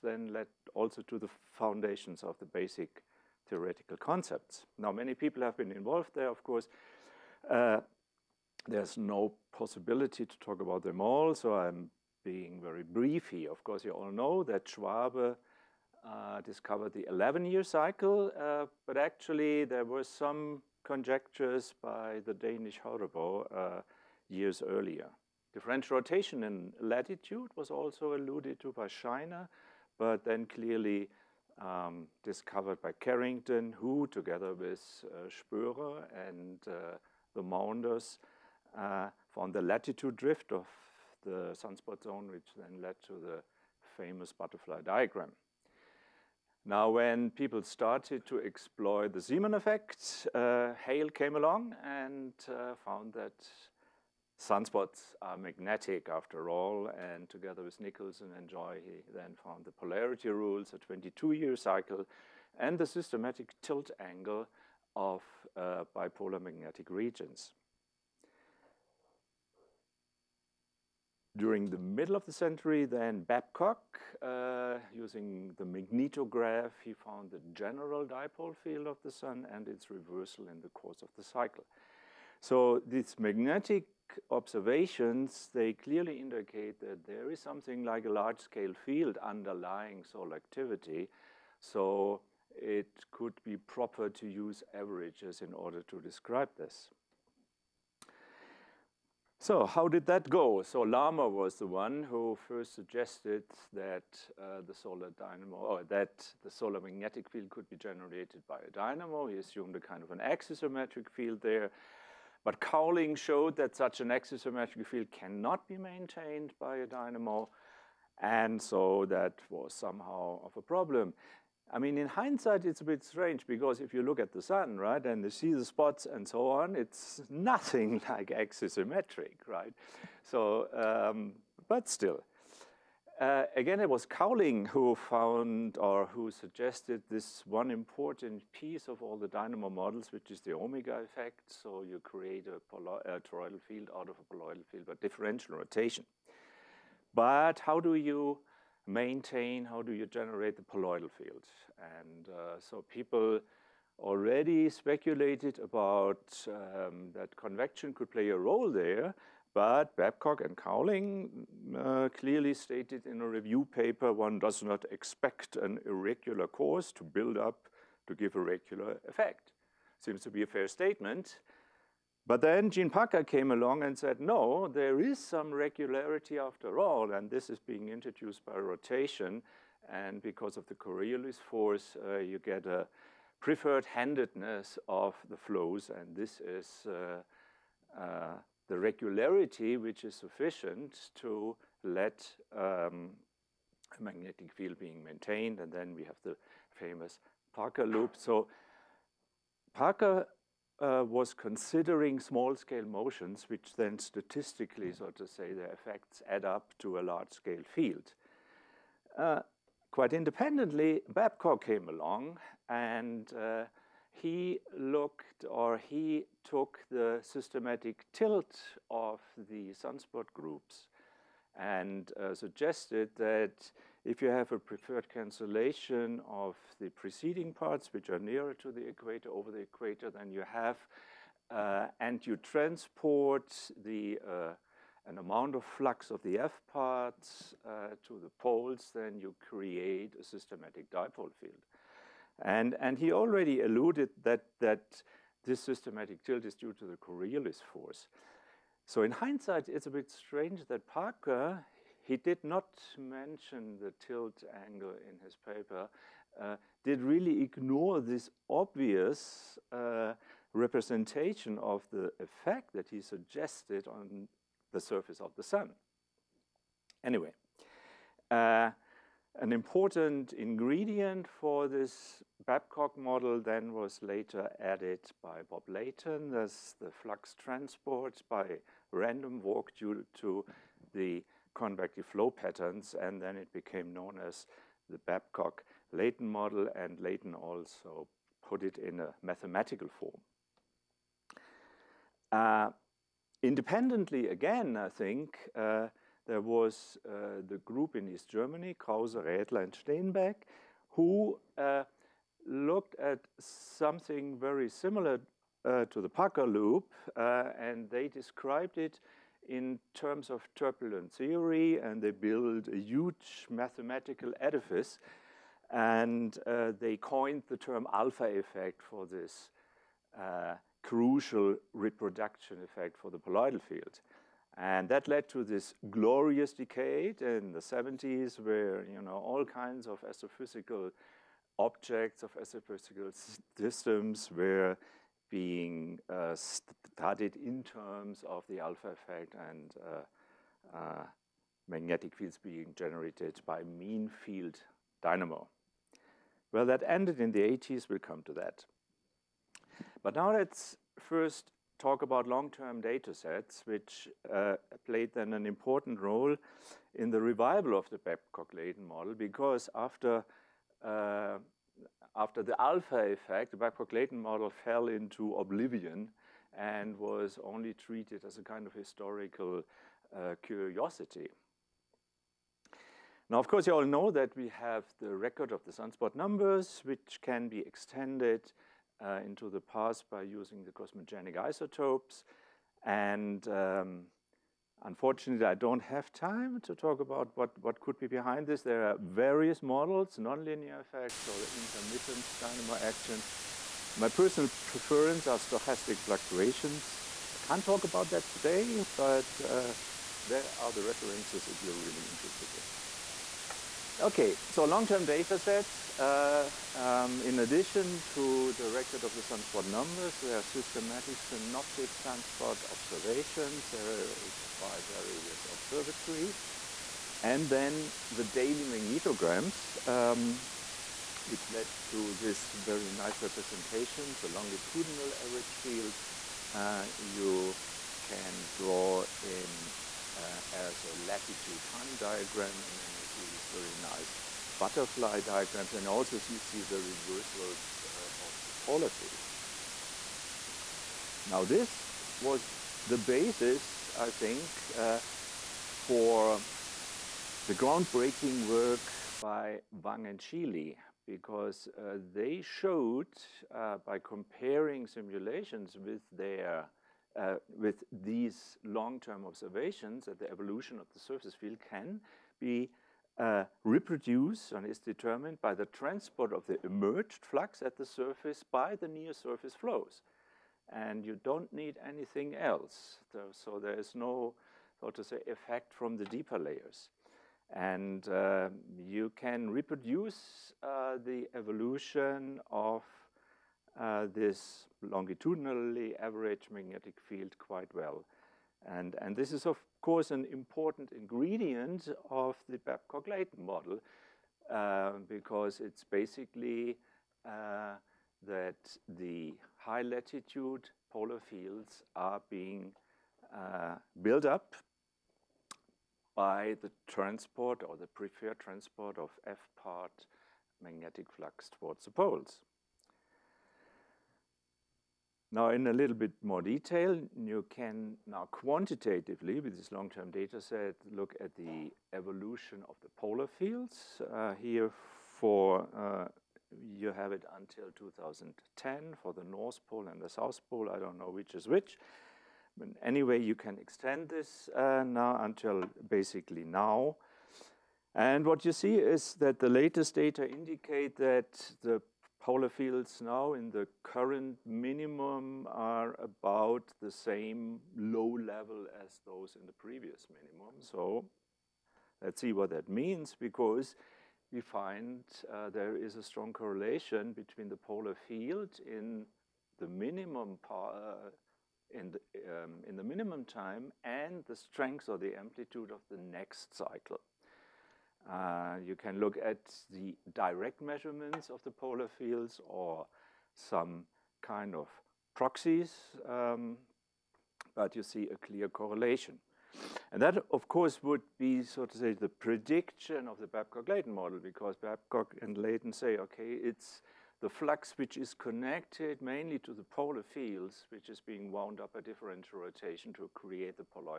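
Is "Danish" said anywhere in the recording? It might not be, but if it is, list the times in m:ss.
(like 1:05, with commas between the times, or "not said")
0:22.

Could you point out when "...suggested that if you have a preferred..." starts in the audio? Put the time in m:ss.
3:42.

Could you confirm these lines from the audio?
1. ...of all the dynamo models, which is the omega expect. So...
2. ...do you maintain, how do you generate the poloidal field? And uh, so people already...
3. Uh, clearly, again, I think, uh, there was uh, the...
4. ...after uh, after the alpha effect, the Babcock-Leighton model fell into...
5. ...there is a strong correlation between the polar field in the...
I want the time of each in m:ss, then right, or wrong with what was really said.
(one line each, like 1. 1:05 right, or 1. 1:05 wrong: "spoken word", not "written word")
1. 2:18 wrong: "effect", not "expect"
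2. 2:27 right
3. 4:52 wrong: "independently", not "clearly"
4. 5:59 right
5. 9:15 right.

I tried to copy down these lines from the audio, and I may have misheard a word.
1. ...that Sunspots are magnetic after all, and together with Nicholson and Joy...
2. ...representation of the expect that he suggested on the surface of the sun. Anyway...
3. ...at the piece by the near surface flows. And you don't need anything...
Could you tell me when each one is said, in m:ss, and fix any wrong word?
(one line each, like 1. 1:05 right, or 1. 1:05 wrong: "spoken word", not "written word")
1. 0:53 right
2. 4:20 wrong: "effect", not "expect"
3. 7:47 wrong: "surface", not "piece".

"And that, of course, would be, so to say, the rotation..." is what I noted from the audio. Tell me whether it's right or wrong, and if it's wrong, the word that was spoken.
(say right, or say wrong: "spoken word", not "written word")
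wrong: "prediction", not "rotation".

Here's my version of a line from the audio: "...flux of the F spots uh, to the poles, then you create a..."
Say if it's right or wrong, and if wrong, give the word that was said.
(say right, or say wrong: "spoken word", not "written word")
wrong: "parts", not "spots".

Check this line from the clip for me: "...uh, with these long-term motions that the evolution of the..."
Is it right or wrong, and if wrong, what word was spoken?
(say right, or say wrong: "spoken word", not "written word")
wrong: "observations", not "motions".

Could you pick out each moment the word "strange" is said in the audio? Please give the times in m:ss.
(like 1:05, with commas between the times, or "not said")
2:03, 4:10.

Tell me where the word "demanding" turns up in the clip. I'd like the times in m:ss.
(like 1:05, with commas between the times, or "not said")
not said.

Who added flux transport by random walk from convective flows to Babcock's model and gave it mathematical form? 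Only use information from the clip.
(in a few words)
Bob Leighton.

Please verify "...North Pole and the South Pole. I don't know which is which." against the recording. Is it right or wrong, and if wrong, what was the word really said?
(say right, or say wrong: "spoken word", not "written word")
right.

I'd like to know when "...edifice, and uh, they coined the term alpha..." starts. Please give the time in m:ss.
5:14.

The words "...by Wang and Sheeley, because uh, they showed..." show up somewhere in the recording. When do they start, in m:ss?
7:29.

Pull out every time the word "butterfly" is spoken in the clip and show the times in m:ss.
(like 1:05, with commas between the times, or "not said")
0:44, 7:14.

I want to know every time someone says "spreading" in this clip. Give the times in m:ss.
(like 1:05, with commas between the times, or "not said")
not said.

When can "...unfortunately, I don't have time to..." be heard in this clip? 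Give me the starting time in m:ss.
6:24.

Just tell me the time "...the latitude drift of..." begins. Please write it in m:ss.
0:39.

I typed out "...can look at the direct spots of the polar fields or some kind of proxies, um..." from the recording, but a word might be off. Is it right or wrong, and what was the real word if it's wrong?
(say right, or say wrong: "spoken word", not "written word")
wrong: "measurements", not "spots".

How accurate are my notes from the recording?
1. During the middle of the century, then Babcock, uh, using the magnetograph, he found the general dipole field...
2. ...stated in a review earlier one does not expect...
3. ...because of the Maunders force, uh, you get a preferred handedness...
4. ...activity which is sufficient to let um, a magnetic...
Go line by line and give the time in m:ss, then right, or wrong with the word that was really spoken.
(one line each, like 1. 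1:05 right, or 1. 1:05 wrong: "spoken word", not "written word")
1. 1:11 right
2. 2:42 wrong: "paper", not "earlier"
3. 3:00 wrong: "Coriolis", not "Maunders"
4. 3:08 wrong: "regularity", not "activity".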